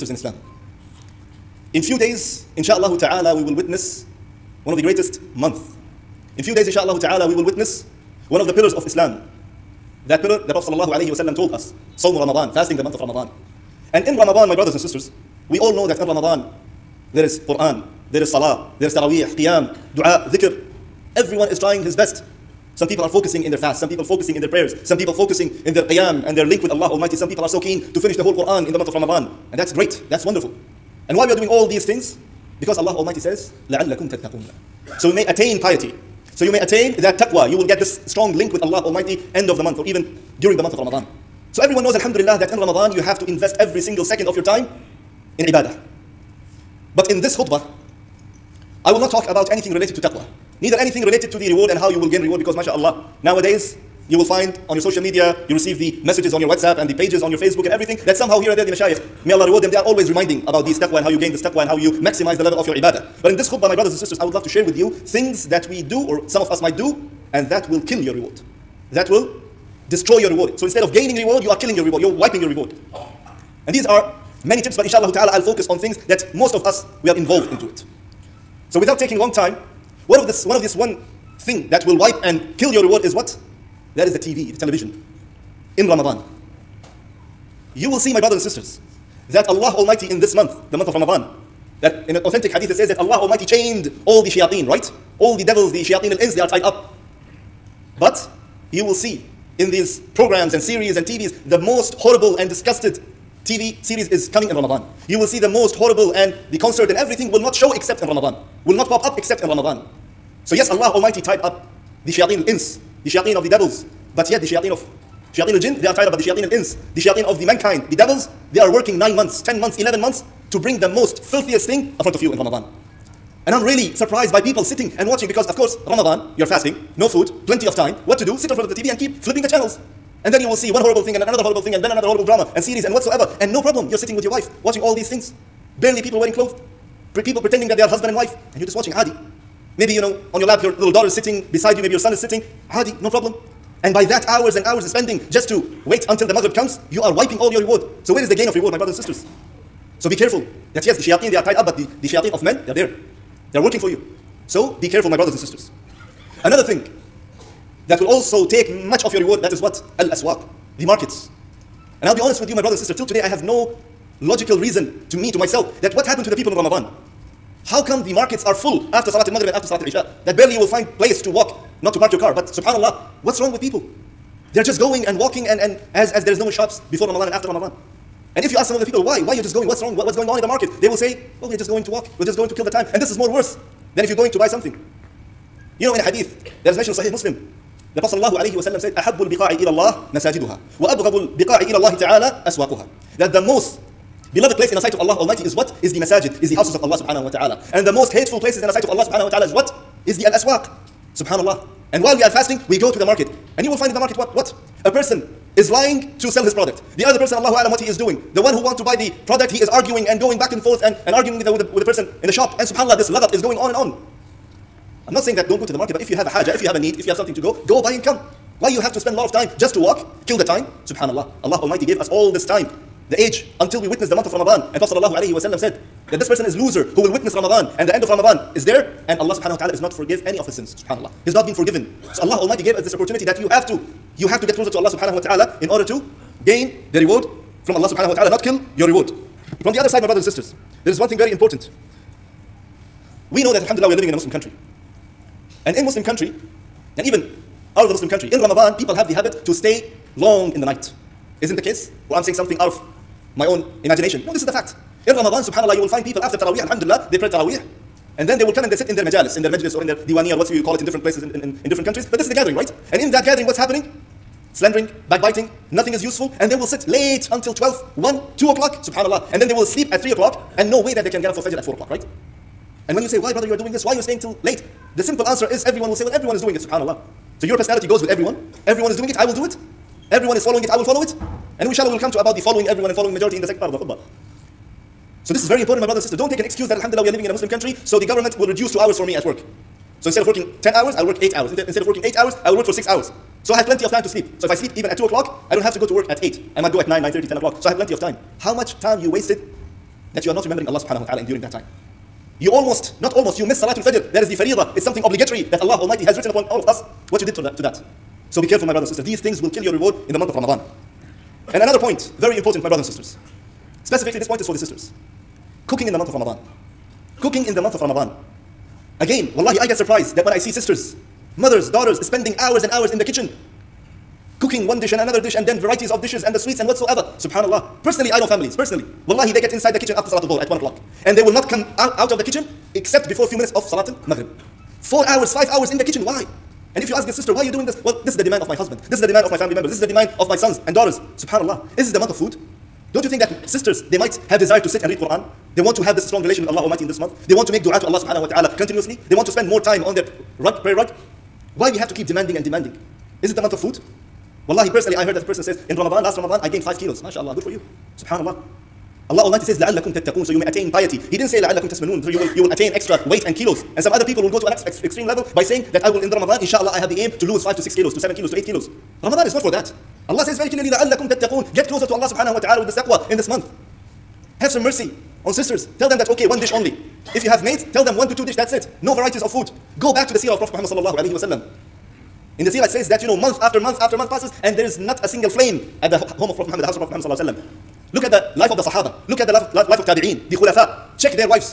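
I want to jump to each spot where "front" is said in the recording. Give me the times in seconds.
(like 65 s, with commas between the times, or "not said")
122 s, 128 s.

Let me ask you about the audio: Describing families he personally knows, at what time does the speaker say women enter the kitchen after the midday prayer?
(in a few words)
1 o'clock.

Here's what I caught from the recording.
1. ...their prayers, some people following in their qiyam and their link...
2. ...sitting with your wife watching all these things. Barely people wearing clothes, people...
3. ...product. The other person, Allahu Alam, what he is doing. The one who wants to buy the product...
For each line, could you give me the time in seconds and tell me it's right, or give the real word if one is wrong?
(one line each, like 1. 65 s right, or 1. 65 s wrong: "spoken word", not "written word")
1. 24 s wrong: "focusing", not "following"
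2. 133 s right
3. 206 s right.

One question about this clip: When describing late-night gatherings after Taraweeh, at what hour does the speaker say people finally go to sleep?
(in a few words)
3 o'clock.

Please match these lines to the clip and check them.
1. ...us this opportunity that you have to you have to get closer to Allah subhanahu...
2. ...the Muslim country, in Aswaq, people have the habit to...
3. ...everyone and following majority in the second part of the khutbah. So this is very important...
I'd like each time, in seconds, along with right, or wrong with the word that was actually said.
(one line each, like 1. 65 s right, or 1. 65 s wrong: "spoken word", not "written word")
1. 232 s right
2. 247 s wrong: "Ramadan", not "Aswaq"
3. 282 s right.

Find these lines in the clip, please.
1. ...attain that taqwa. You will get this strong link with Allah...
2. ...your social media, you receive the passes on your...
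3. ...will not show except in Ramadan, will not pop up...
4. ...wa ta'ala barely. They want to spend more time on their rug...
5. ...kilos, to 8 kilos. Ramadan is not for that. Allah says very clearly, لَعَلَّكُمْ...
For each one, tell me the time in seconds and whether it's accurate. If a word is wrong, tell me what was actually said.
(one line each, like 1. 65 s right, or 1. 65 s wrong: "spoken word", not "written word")
1. 36 s right
2. 54 s wrong: "messages", not "passes"
3. 107 s right
4. 348 s wrong: "continuously", not "barely"
5. 368 s right.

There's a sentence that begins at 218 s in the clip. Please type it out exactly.
Why you have to spend a lot of time just to walk, kill the time?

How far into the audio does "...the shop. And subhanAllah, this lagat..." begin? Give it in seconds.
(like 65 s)
212 s.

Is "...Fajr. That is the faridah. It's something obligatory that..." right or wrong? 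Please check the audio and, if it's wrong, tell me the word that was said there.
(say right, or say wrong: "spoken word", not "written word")
right.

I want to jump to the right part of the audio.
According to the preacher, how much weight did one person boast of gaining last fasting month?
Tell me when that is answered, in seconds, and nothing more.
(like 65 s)
356 s.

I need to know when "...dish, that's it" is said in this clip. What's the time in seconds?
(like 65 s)
378 s.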